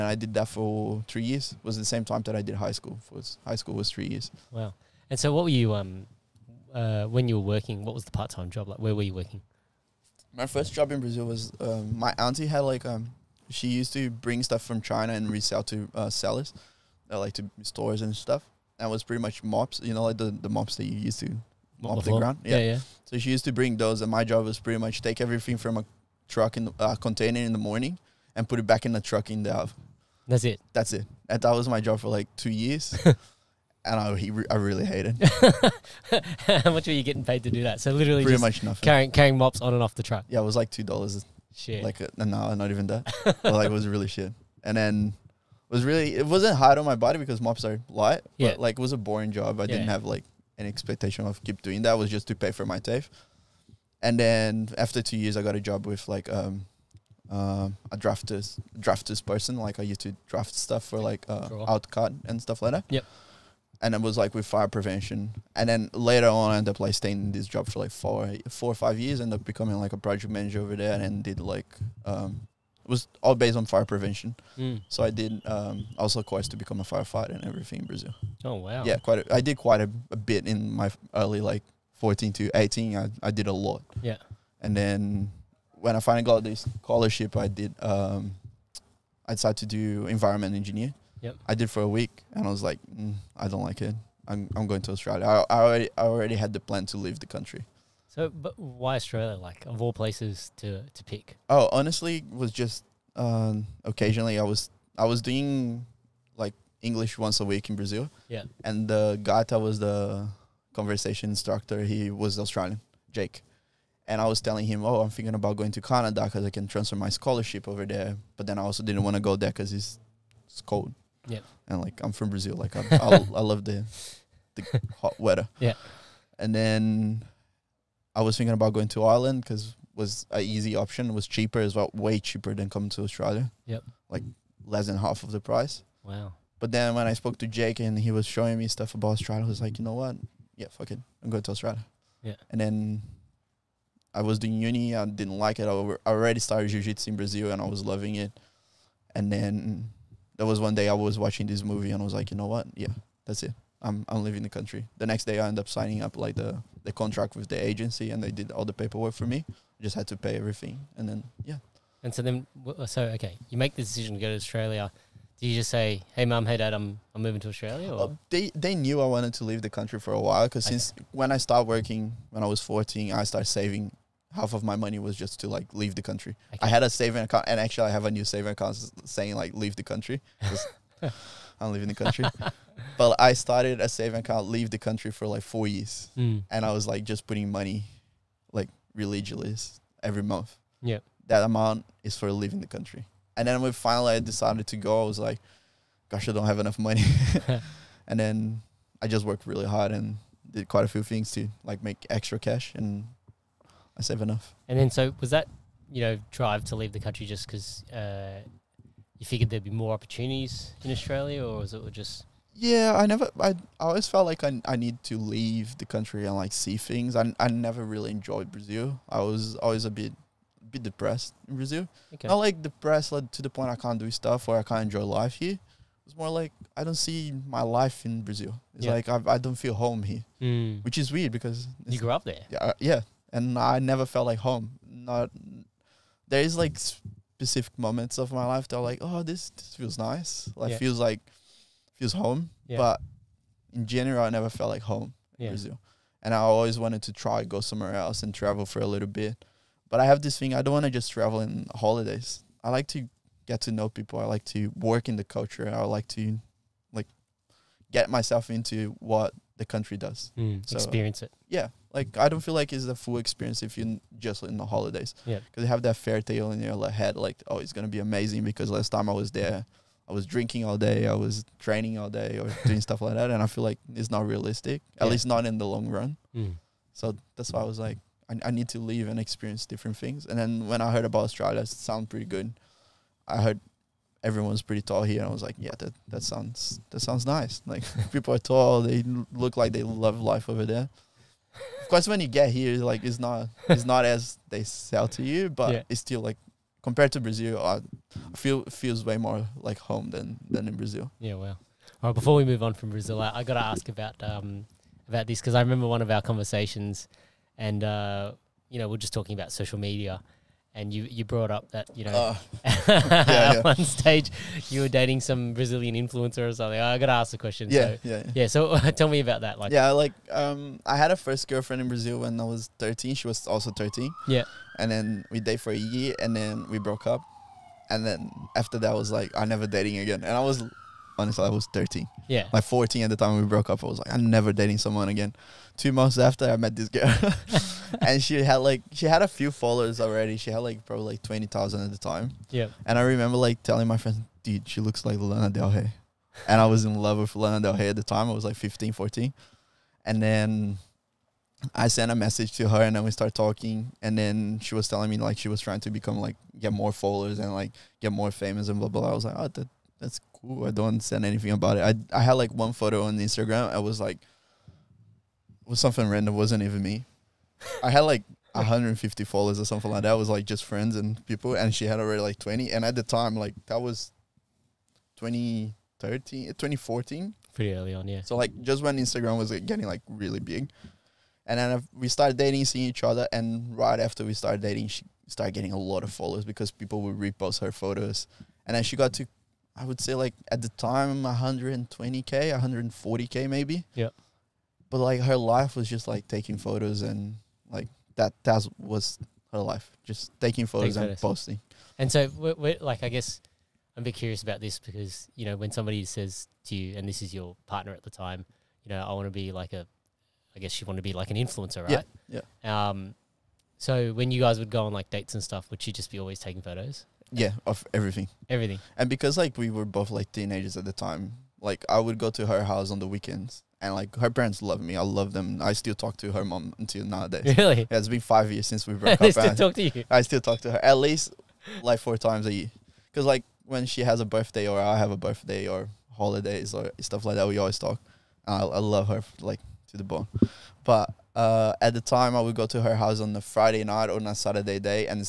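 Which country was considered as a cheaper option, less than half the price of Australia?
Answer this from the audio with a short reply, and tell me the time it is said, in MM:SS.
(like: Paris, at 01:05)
Ireland, at 02:09.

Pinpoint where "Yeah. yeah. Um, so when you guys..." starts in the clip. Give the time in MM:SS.
06:52.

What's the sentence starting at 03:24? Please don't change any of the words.
And then, so was that you know drive to leave the country just because?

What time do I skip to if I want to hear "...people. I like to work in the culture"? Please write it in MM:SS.
04:13.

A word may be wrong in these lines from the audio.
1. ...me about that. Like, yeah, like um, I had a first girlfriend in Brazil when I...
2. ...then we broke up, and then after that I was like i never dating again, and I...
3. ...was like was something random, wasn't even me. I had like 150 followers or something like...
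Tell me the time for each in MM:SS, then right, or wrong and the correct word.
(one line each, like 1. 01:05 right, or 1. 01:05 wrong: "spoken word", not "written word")
1. 05:19 right
2. 05:26 right
3. 06:03 right.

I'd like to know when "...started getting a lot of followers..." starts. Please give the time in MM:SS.
06:25.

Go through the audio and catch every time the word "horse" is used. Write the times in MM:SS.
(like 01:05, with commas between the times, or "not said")
not said.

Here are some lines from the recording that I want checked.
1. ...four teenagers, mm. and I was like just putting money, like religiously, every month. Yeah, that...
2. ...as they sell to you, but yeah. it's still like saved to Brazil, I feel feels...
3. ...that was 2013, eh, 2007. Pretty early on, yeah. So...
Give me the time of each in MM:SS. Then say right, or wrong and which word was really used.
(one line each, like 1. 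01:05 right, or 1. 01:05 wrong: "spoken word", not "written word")
1. 03:05 wrong: "years", not "teenagers"
2. 04:54 wrong: "compared", not "saved"
3. 06:13 wrong: "2014", not "2007".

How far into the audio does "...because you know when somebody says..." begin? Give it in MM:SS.
06:44.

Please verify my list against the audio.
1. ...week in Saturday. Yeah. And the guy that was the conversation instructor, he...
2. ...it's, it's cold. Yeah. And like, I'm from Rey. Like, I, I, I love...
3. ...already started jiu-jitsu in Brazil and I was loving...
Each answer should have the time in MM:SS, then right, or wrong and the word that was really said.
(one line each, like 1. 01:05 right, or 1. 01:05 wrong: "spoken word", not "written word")
1. 01:47 wrong: "Brazil", not "Saturday"
2. 01:59 wrong: "Brazil", not "Rey"
3. 02:26 right.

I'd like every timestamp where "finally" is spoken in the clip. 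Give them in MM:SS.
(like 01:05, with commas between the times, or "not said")
01:26, 03:13.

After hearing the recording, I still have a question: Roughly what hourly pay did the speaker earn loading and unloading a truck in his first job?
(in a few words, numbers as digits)
2 dollars.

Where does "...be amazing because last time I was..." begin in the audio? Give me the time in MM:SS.
04:27.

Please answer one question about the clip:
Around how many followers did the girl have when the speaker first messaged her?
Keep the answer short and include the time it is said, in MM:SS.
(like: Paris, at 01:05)
20,000, at 05:41.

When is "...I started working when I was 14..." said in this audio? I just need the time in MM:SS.
02:51.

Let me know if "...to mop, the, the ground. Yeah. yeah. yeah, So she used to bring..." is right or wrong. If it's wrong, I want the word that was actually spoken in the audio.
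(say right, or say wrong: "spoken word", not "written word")
right.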